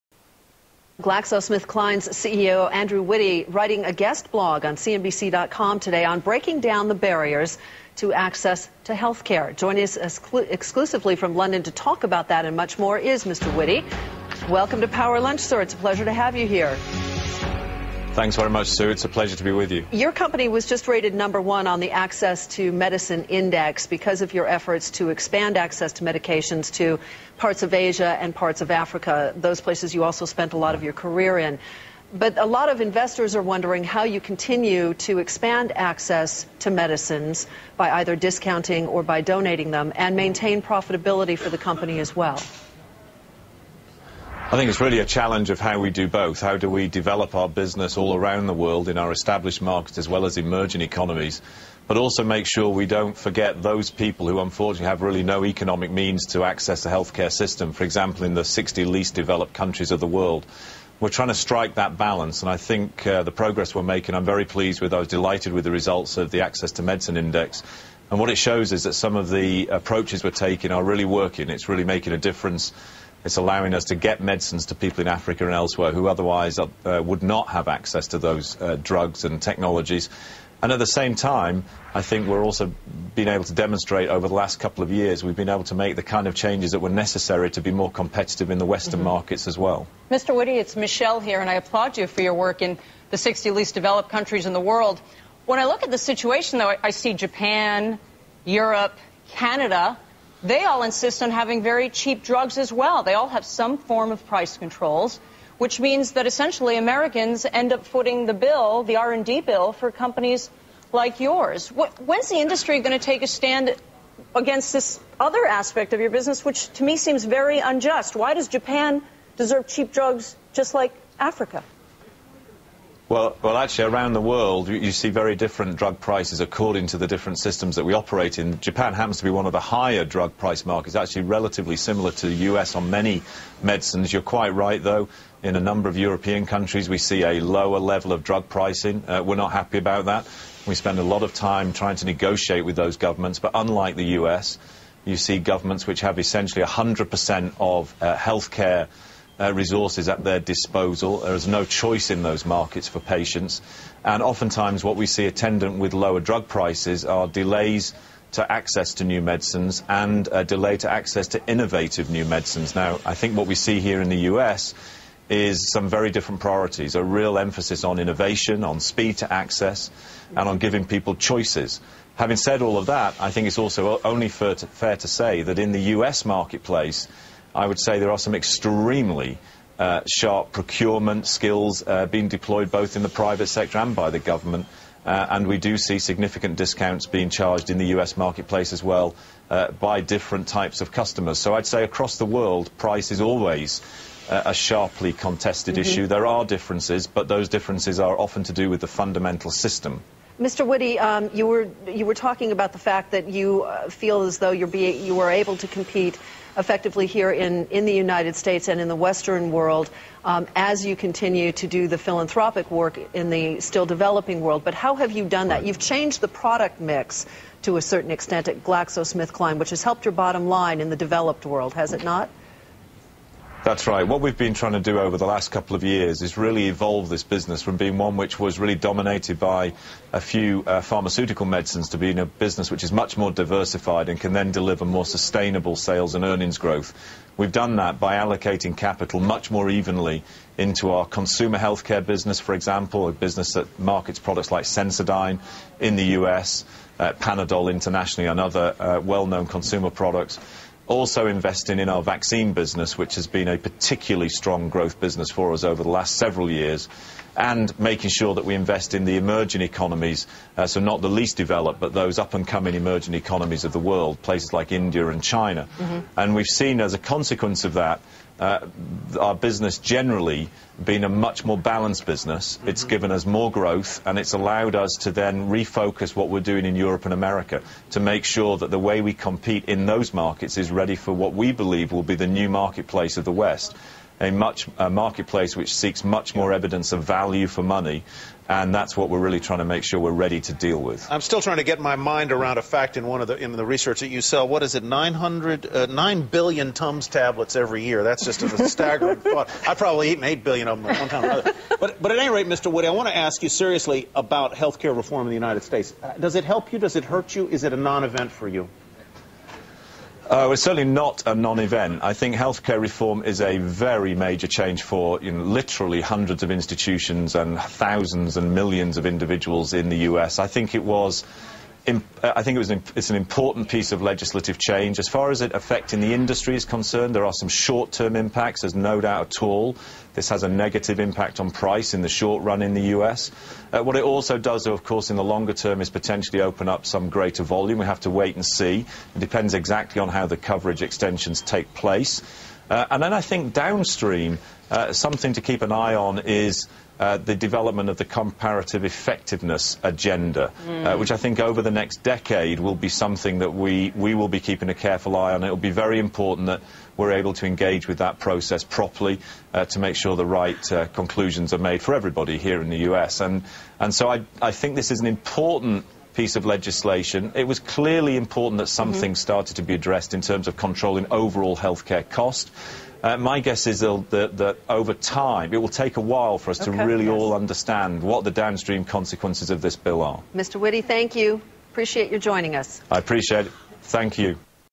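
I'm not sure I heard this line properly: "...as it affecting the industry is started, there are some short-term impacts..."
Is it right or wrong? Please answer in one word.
wrong.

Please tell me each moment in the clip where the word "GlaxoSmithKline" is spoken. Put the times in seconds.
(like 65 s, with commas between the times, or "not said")
1 s, 218 s.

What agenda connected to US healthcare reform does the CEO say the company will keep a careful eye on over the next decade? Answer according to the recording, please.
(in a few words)
comparative effectiveness.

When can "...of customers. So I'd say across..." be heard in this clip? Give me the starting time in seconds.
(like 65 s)
190 s.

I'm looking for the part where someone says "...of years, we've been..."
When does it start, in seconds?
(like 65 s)
84 s.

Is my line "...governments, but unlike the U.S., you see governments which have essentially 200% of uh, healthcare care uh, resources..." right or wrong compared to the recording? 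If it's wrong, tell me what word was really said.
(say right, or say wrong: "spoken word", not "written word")
wrong: "100", not "200".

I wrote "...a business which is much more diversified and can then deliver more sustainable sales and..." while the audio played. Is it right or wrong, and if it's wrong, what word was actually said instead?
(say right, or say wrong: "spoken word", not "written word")
right.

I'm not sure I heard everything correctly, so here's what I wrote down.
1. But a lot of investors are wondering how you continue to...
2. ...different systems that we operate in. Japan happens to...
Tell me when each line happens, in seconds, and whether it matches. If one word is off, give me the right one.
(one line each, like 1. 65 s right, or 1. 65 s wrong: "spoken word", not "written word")
1. 32 s right
2. 127 s right.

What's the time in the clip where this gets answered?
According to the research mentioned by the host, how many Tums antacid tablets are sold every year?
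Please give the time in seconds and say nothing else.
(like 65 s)
295 s.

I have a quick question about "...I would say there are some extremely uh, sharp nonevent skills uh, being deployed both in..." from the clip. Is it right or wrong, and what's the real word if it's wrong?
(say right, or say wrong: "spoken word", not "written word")
wrong: "procurement", not "nonevent".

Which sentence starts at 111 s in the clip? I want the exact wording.
When's the industry going to take a stand against this other aspect of your business, which to me seems very unjust?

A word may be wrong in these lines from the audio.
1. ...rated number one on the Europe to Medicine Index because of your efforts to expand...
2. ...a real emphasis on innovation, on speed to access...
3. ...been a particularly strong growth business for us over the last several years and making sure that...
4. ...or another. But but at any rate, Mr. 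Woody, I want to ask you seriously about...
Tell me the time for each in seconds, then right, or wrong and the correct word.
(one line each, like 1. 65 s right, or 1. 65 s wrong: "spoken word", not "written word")
1. 20 s wrong: "Access", not "Europe"
2. 166 s right
3. 253 s right
4. 301 s right.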